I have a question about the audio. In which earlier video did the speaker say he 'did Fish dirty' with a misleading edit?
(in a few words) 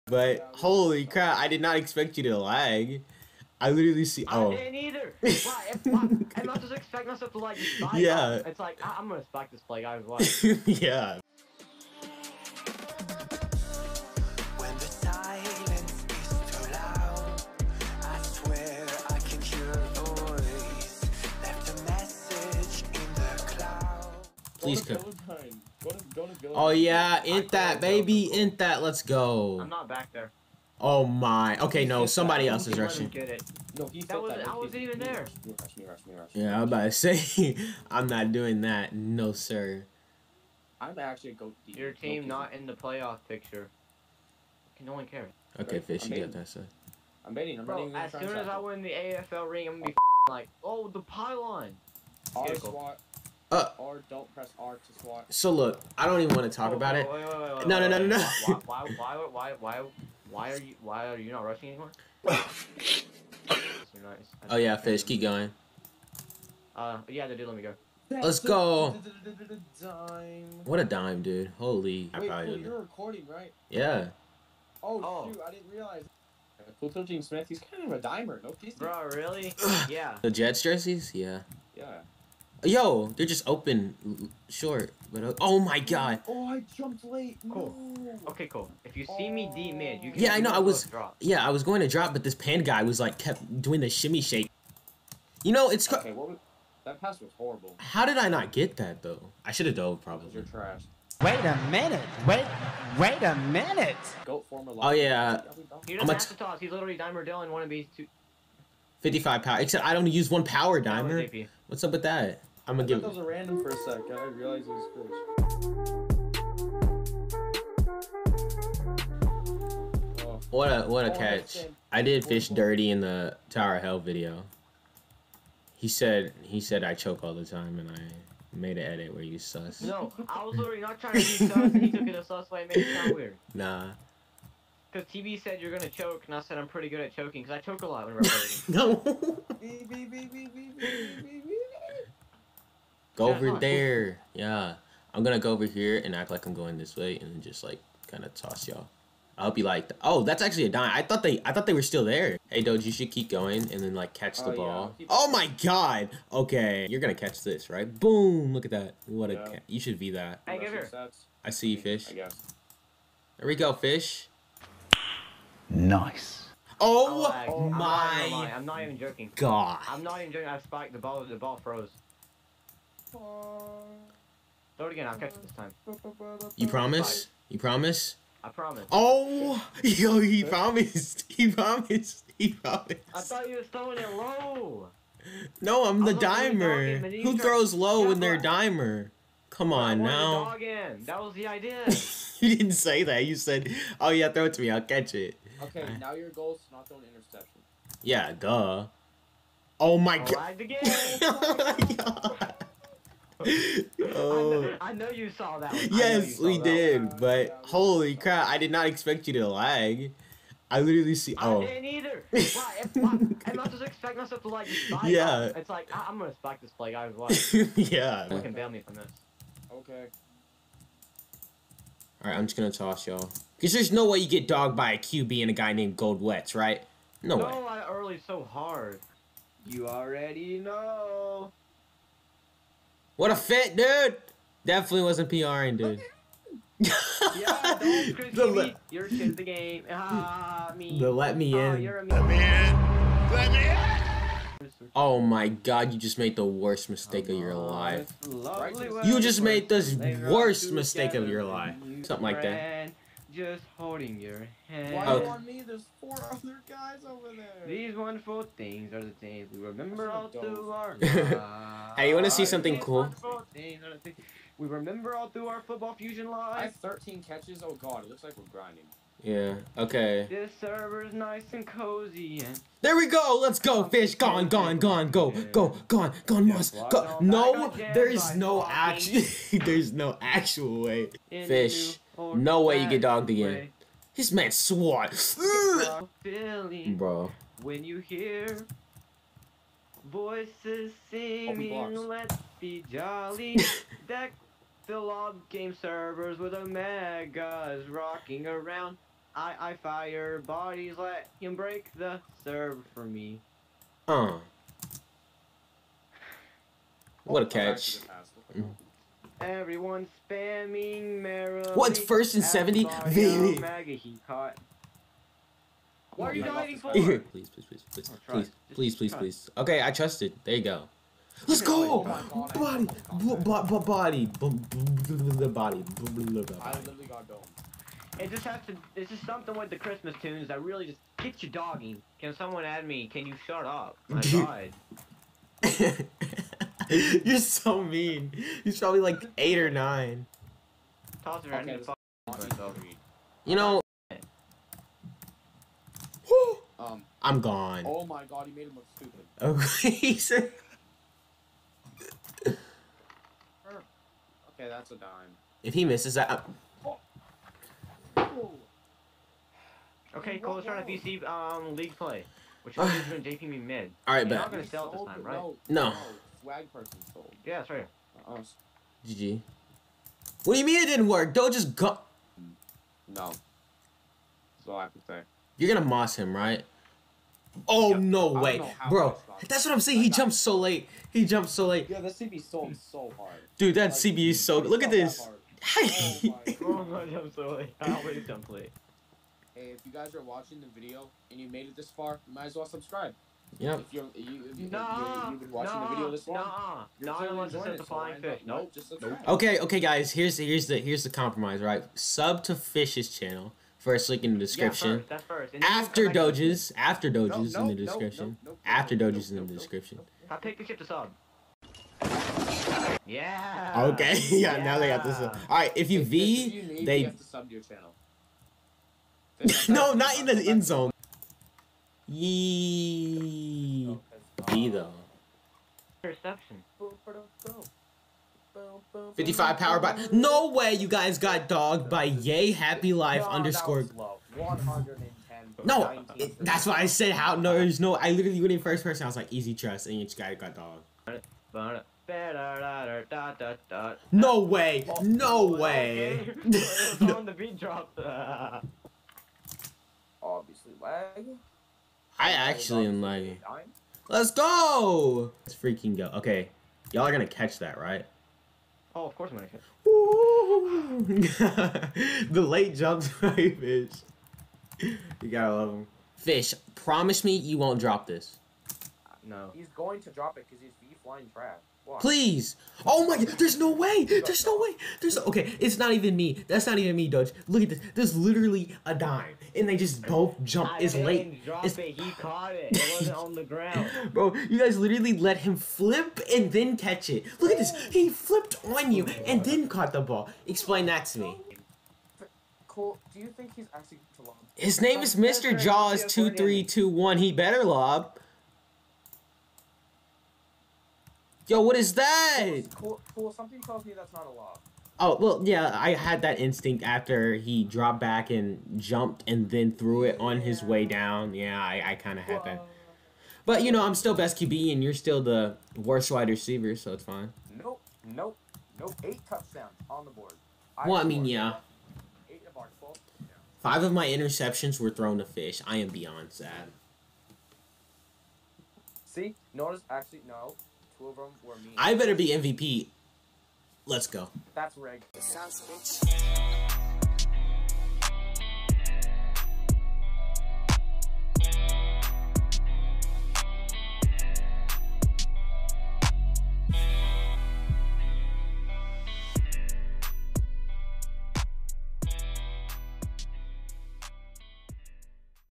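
Tower Hell video.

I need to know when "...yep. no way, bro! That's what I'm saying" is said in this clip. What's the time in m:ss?
6:17.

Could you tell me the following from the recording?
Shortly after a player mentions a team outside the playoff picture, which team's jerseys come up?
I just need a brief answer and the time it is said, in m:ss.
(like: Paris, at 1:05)
Jets, at 1:20.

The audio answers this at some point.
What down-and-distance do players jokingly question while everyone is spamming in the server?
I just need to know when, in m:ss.
5:11.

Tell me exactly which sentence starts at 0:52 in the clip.
All SWAT, uh, or don't press R to swap.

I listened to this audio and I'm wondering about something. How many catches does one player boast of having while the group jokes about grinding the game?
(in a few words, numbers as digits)
13.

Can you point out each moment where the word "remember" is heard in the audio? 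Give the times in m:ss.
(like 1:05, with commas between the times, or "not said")
4:19, 4:24.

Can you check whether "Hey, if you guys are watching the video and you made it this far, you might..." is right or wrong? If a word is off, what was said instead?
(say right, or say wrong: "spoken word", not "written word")
right.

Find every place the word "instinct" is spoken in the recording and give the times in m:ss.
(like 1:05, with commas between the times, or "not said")
8:26.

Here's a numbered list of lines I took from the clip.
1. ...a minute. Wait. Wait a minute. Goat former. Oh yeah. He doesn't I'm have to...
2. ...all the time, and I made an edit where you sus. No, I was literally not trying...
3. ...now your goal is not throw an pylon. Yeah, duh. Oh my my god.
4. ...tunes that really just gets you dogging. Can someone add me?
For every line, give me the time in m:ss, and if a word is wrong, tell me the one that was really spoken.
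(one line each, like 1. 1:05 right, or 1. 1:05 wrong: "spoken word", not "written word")
1. 1:41 right
2. 2:07 right
3. 3:15 wrong: "interception", not "pylon"
4. 5:30 right.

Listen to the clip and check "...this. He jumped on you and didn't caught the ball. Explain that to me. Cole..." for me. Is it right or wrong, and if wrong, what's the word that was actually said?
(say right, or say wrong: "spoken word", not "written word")
wrong: "flipped", not "jumped".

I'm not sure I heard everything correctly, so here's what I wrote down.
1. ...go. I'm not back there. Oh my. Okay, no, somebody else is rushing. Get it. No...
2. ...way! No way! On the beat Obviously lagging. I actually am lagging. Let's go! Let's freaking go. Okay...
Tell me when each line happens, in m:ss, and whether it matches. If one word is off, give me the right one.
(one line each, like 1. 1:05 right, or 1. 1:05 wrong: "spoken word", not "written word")
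1. 0:29 right
2. 7:24 right.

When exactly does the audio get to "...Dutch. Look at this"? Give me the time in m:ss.
7:57.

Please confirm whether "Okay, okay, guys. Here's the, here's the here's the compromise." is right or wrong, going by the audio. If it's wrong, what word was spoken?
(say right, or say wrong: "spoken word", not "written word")
right.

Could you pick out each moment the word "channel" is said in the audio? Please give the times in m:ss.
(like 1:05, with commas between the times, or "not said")
6:43, 6:57.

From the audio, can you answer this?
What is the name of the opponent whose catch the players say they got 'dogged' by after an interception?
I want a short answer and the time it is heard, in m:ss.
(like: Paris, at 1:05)
Yay Happy Life, at 7:12.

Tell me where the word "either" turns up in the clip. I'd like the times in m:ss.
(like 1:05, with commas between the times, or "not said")
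0:04, 3:31.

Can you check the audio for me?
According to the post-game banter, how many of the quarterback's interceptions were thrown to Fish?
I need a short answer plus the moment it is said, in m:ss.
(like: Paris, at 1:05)
5, at 8:43.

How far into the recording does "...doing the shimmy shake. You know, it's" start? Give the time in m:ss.
1:33.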